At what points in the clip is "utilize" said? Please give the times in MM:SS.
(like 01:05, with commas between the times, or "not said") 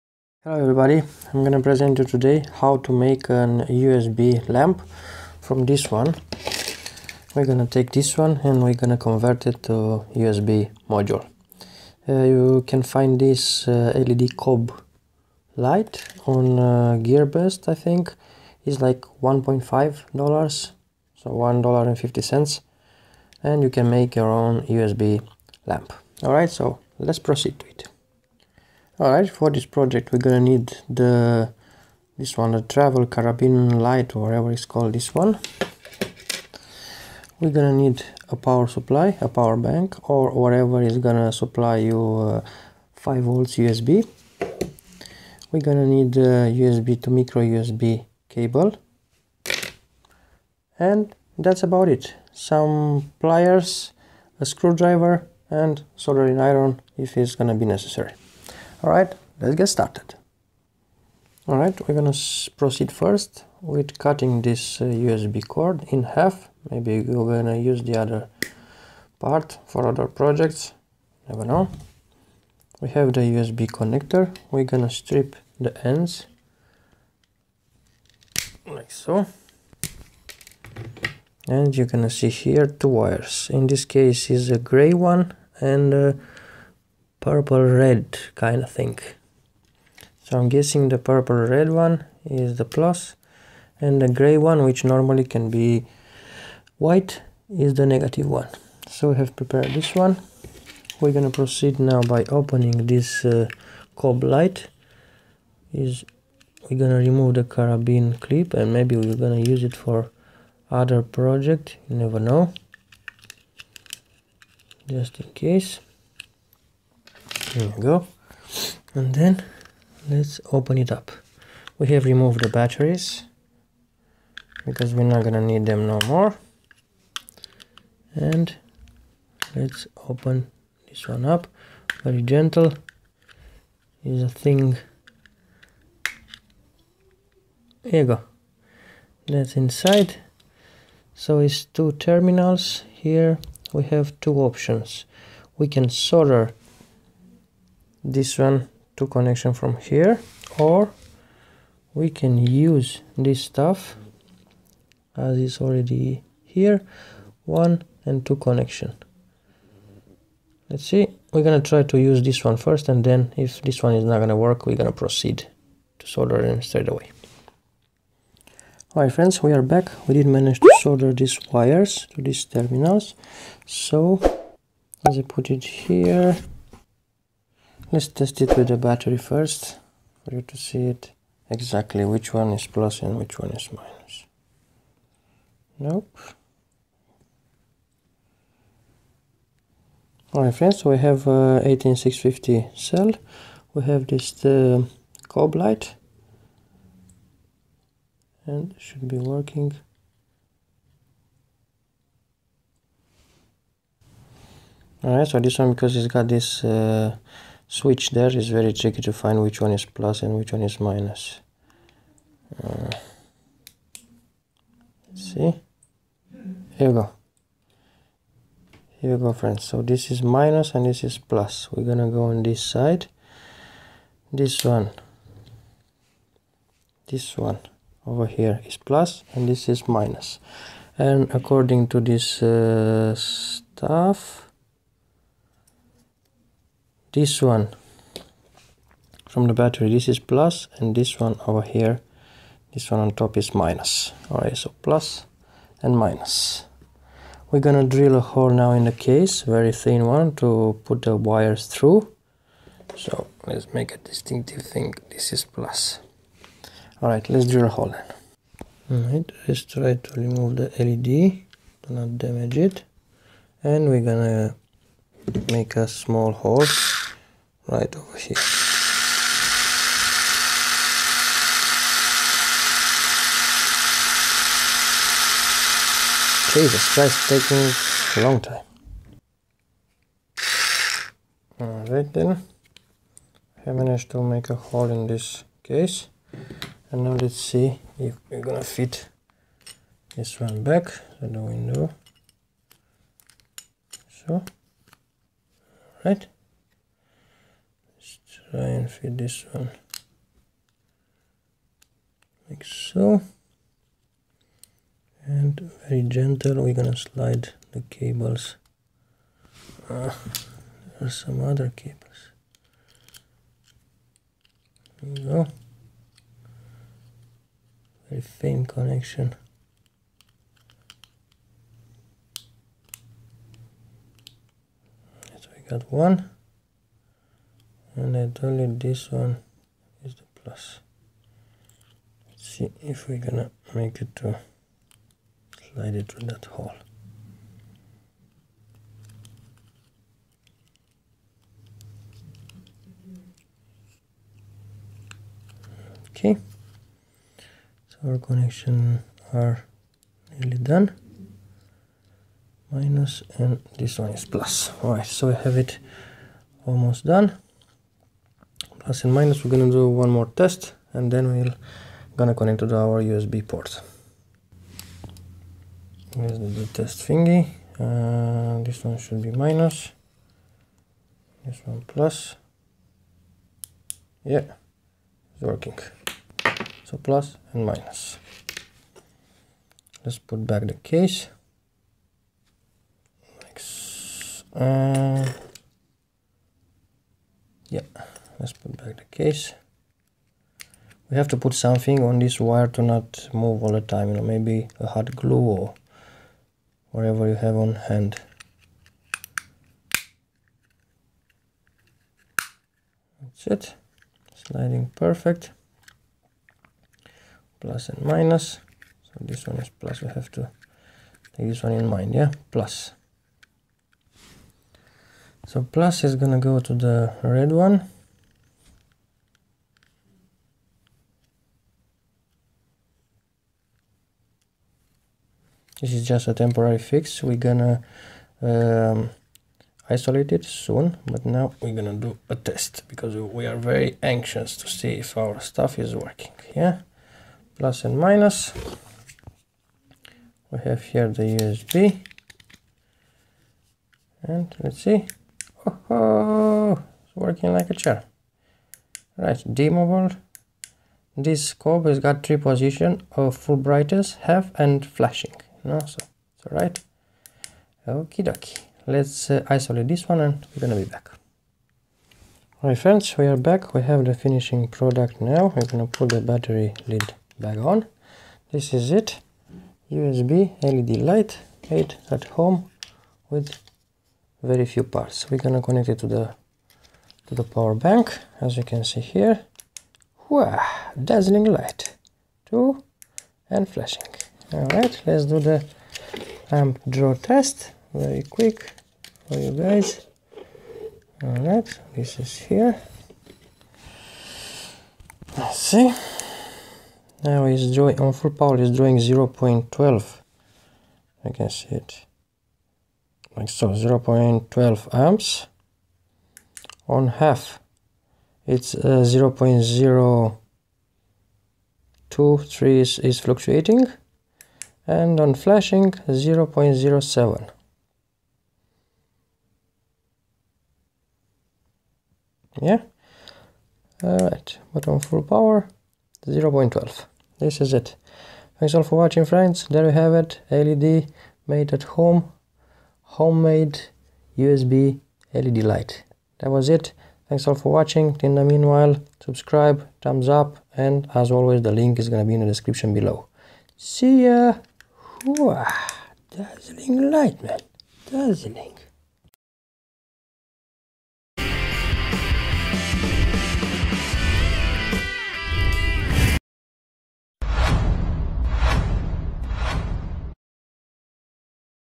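not said.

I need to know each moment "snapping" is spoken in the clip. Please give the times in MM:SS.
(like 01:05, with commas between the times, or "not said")
not said.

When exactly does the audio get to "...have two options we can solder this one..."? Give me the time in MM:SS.
02:23.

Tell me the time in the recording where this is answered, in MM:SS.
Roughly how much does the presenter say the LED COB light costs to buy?
00:21.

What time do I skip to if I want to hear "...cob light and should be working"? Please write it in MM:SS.
03:15.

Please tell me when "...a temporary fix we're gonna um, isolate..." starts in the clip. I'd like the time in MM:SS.
07:06.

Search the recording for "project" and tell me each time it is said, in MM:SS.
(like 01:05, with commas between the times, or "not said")
00:29, 01:10, 01:51.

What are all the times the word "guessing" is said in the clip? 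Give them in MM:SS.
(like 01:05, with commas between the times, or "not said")
01:30.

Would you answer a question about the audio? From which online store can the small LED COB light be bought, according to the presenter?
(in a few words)
Gearbest.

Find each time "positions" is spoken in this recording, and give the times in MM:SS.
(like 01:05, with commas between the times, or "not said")
07:32.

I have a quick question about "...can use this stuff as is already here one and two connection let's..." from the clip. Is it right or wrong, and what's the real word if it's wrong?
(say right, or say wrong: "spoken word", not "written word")
right.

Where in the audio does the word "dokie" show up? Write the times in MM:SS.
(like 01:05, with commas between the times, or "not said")
07:38.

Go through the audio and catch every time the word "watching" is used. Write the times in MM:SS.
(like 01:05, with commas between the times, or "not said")
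08:49, 08:57.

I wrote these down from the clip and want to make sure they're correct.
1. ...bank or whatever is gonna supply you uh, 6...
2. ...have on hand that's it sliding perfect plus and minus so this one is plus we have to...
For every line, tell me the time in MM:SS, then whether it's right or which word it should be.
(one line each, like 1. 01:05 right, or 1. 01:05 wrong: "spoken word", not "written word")
1. 00:39 wrong: "5", not "6"
2. 06:37 right.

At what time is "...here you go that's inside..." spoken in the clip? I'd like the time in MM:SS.
02:17.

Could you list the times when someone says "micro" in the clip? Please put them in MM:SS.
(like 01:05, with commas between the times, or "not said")
00:47.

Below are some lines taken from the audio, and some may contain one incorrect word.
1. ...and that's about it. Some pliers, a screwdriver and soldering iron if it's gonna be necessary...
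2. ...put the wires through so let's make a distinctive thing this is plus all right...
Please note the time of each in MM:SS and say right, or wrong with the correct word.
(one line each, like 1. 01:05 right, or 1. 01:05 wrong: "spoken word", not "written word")
1. 00:50 right
2. 04:10 right.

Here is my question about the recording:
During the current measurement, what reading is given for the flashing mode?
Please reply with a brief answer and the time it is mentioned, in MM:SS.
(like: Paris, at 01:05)
0.07, at 08:35.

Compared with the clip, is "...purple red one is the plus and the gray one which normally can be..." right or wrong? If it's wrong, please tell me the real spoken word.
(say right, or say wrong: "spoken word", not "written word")
right.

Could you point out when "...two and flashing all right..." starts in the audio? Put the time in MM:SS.
08:02.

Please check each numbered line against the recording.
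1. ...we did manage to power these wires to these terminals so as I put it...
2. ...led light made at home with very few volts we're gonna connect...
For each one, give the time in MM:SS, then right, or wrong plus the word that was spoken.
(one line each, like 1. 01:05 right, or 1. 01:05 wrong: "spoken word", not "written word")
1. 02:50 wrong: "solder", not "power"
2. 07:50 wrong: "parts", not "volts".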